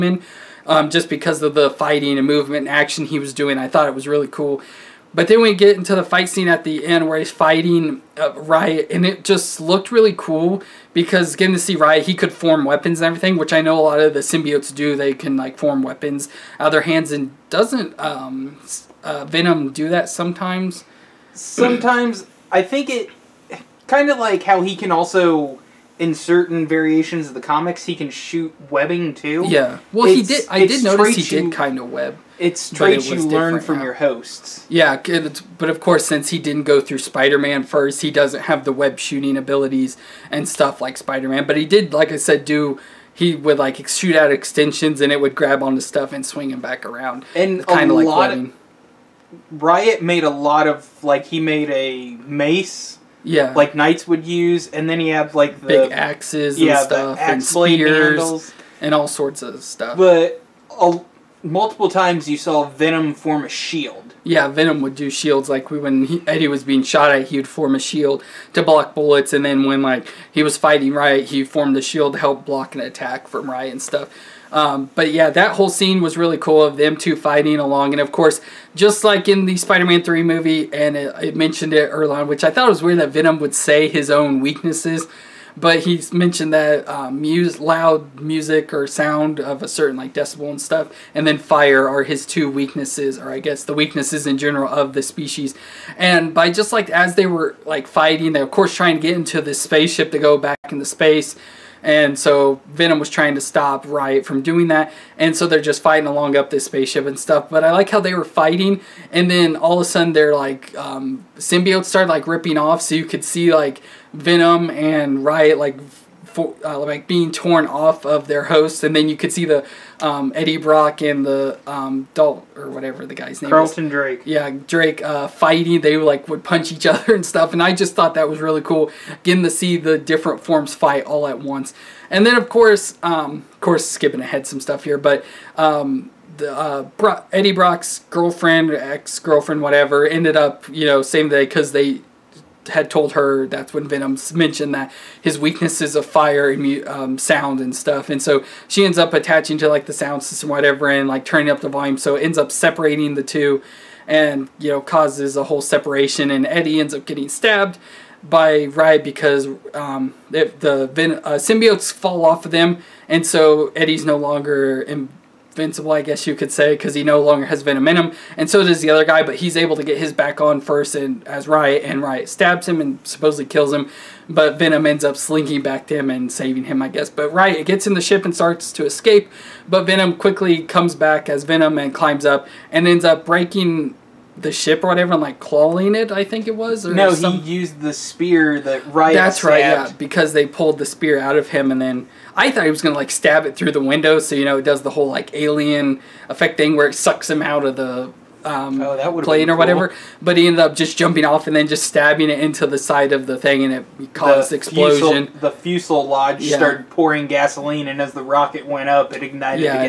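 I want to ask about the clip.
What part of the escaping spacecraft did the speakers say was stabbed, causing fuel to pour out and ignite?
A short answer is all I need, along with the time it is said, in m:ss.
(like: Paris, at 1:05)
The fuselage, at 3:25.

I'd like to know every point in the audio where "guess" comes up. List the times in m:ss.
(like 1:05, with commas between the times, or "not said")
1:33, 2:46, 2:56.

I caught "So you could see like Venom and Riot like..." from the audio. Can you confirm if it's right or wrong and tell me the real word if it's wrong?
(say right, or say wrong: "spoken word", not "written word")
right.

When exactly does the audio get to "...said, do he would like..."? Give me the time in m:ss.
0:42.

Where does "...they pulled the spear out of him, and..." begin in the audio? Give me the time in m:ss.
3:10.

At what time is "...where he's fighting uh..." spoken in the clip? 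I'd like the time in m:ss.
0:07.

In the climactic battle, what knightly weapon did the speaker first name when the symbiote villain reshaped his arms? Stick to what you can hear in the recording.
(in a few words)
Mace.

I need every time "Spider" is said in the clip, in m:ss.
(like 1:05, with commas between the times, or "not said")
0:36, 0:40, 1:19.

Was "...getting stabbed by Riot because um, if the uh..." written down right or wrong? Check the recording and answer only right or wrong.
right.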